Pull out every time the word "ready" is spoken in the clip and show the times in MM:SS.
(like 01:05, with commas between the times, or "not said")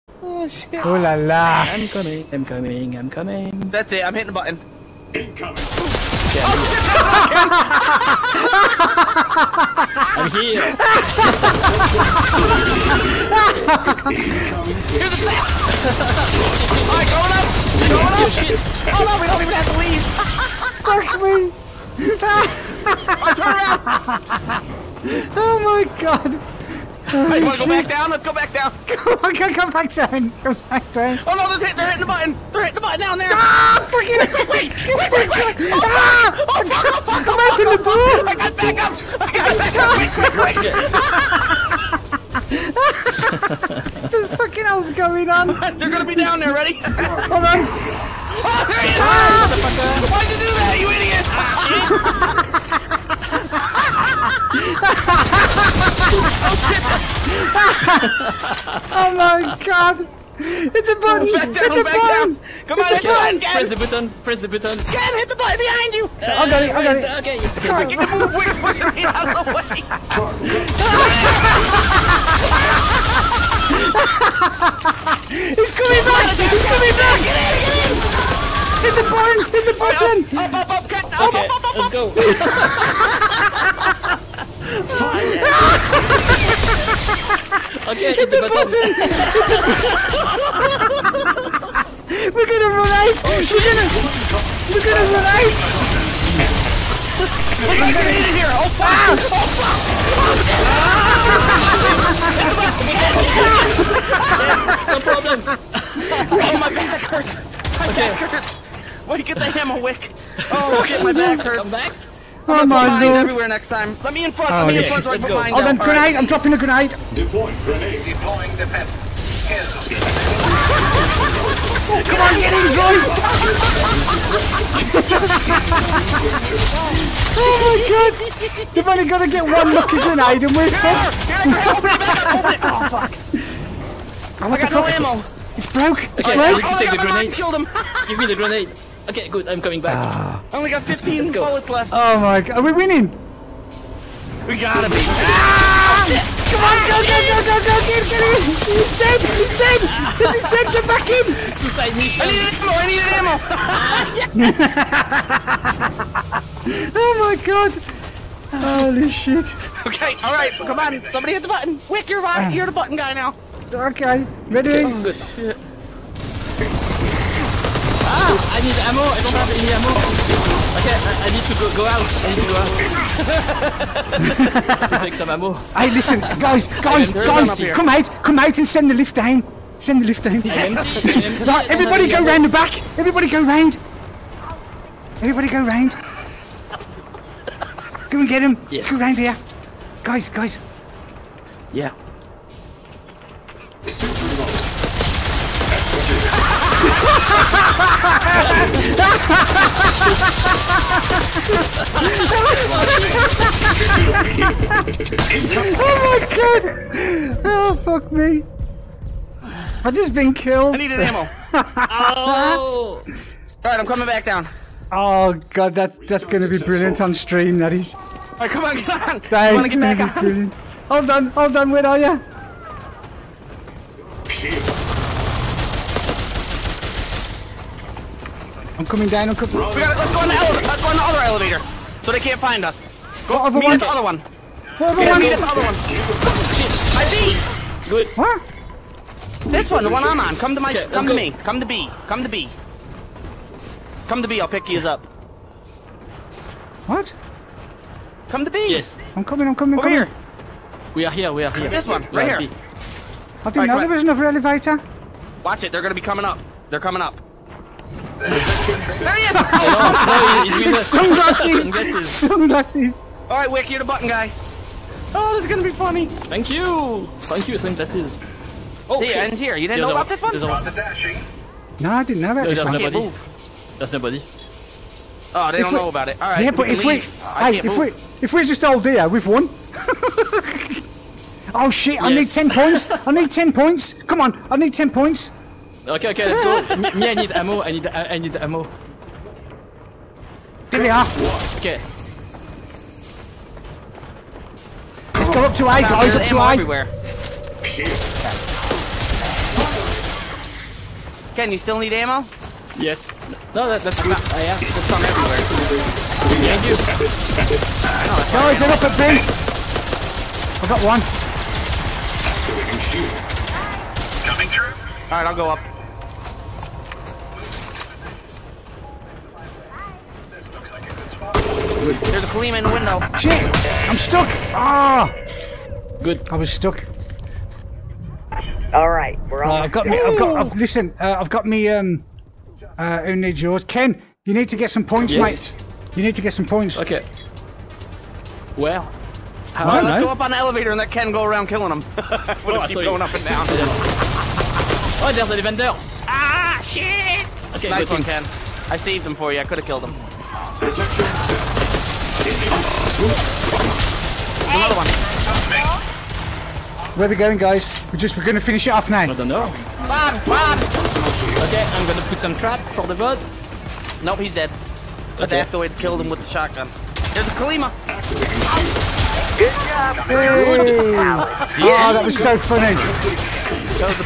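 00:46, 02:44.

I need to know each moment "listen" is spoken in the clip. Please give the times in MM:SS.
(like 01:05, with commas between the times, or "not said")
02:55, 05:30.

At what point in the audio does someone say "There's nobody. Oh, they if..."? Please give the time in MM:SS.
04:33.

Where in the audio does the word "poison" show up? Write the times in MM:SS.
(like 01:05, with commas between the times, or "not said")
not said.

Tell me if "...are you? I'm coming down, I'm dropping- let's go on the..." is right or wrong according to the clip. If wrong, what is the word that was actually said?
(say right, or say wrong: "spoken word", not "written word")
wrong: "coming", not "dropping".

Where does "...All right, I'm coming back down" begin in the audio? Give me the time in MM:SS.
03:33.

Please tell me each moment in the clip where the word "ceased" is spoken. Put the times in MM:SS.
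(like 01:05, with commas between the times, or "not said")
not said.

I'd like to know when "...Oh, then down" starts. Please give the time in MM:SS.
01:55.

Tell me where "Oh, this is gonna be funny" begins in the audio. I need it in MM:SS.
04:25.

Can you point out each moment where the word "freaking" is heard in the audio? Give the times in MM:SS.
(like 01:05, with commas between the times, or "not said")
00:33.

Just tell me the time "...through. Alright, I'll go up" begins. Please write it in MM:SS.
05:14.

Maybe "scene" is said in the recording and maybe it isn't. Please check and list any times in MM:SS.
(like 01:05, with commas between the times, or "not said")
not said.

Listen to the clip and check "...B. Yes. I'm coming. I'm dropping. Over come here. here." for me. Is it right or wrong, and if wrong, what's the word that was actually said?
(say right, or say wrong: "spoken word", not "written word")
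wrong: "coming", not "dropping".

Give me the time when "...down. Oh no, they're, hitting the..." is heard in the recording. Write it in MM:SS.
00:30.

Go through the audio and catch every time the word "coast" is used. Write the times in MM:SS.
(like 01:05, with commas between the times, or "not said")
not said.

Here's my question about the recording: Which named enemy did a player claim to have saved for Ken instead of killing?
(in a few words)
Lady Vendel.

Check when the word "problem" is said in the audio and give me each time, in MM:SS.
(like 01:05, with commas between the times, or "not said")
01:45.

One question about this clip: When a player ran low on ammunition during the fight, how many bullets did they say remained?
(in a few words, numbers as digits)
15.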